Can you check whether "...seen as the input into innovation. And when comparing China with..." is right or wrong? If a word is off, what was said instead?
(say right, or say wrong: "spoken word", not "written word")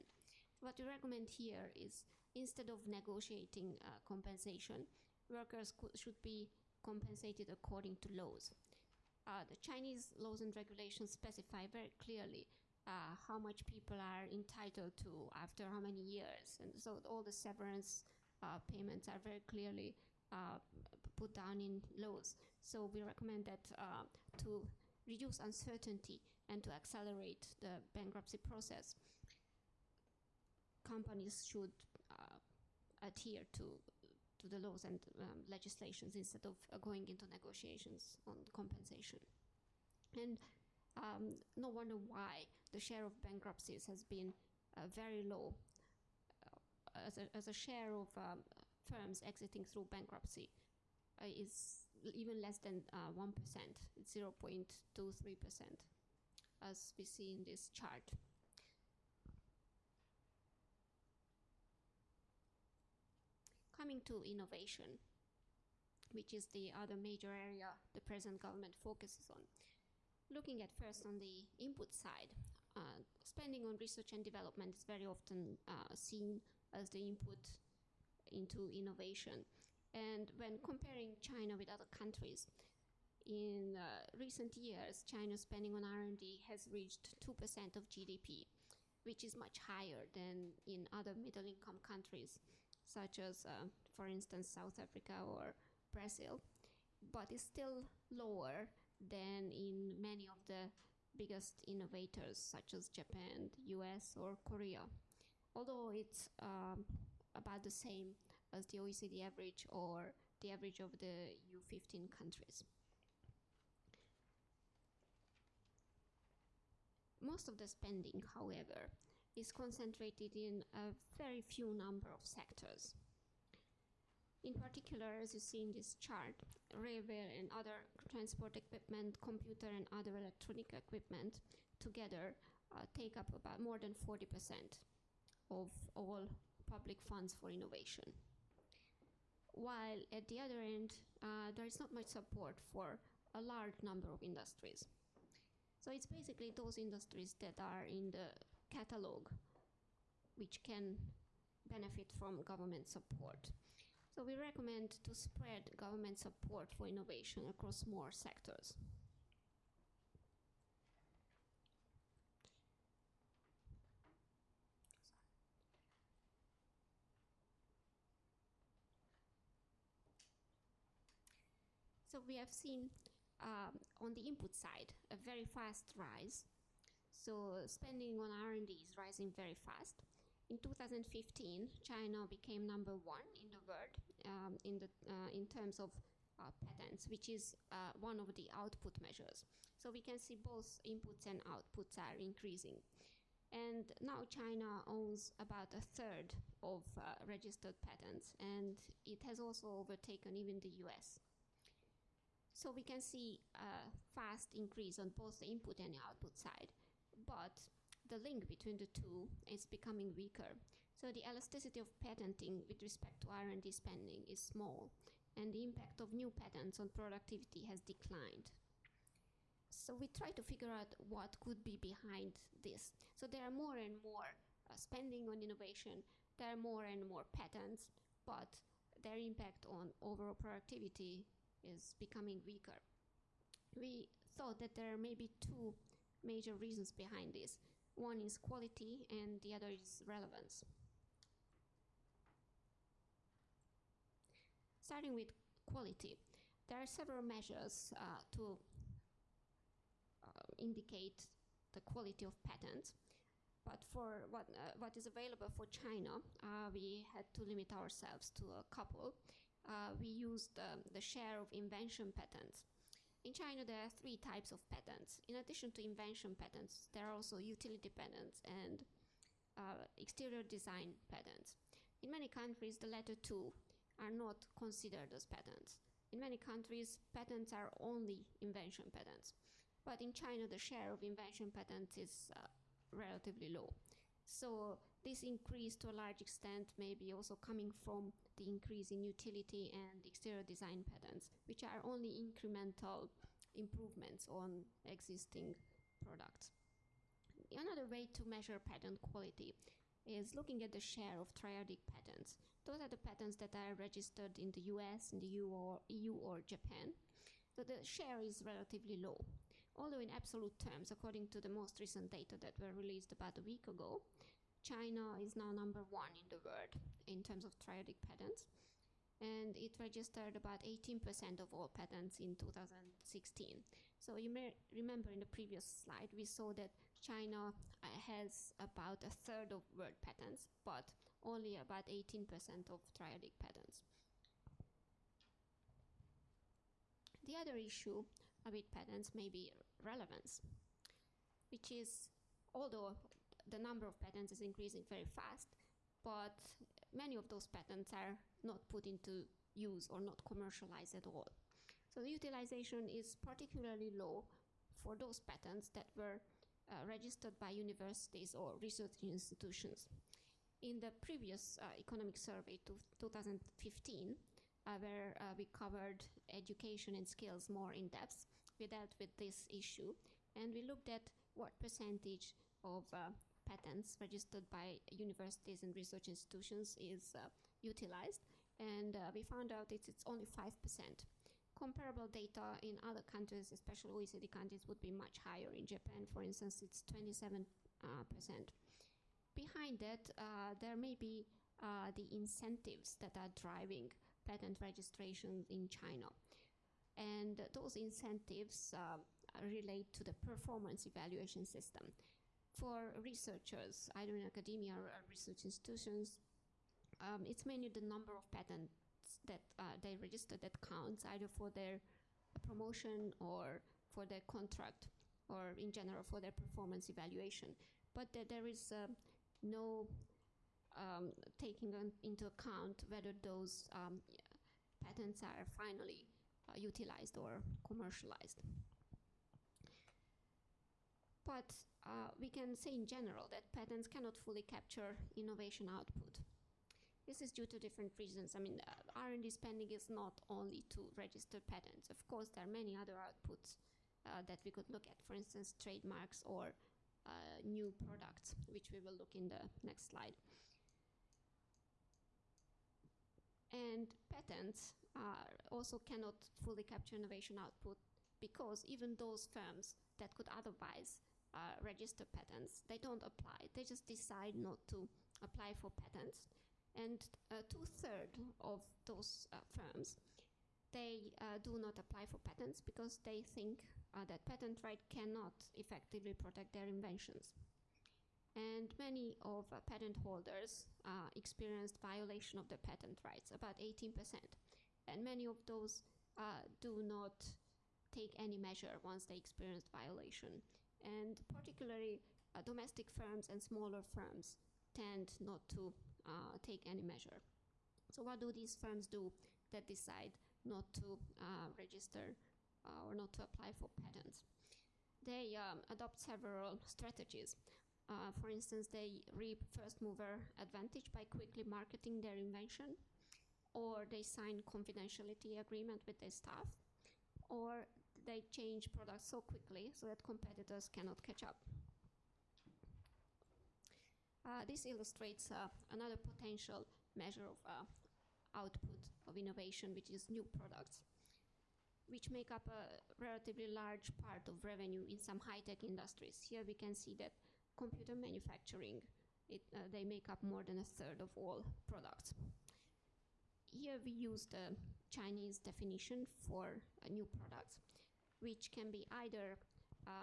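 right.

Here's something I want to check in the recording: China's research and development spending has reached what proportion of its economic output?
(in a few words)
2% of GDP.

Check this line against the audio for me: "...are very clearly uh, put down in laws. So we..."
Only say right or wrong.
right.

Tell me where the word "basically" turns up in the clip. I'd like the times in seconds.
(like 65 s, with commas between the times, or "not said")
146 s.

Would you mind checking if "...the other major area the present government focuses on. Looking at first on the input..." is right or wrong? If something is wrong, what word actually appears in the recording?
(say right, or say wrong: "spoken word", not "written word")
right.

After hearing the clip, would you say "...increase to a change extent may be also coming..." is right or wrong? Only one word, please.
wrong.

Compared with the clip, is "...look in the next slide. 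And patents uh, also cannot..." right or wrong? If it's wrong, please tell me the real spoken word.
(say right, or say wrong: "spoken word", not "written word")
right.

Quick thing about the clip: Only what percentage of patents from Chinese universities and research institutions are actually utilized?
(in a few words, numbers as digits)
5%.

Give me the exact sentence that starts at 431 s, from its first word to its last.
But uh, we can say in general that patents cannot fully capture innovation output.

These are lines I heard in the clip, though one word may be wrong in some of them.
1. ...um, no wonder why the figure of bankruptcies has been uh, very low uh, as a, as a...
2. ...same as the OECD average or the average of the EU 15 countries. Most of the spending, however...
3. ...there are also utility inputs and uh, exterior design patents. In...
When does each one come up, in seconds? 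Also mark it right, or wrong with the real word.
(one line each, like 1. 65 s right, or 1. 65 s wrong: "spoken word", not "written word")
1. 40 s wrong: "share", not "figure"
2. 107 s right
3. 266 s wrong: "patents", not "inputs".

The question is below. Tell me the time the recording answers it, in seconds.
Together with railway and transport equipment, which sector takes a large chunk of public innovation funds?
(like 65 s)
129 s.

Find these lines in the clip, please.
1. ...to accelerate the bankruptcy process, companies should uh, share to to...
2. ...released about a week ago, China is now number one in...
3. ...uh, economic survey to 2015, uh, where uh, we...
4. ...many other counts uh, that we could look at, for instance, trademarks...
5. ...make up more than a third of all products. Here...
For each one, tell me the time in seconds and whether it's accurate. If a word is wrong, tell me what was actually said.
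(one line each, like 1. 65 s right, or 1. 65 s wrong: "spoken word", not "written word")
1. 26 s wrong: "adhere", not "share"
2. 312 s right
3. 361 s right
4. 442 s wrong: "outputs", not "counts"
5. 539 s right.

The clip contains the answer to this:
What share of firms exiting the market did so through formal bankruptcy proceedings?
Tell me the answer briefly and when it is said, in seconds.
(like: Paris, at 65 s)
0.23%, at 54 s.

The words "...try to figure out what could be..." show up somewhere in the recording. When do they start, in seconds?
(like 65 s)
220 s.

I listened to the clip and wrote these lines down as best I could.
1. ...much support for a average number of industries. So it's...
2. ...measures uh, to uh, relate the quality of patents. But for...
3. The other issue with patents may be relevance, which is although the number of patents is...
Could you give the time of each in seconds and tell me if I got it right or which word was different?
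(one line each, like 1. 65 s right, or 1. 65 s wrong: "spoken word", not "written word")
1. 141 s wrong: "large", not "average"
2. 247 s wrong: "indicate", not "relate"
3. 337 s right.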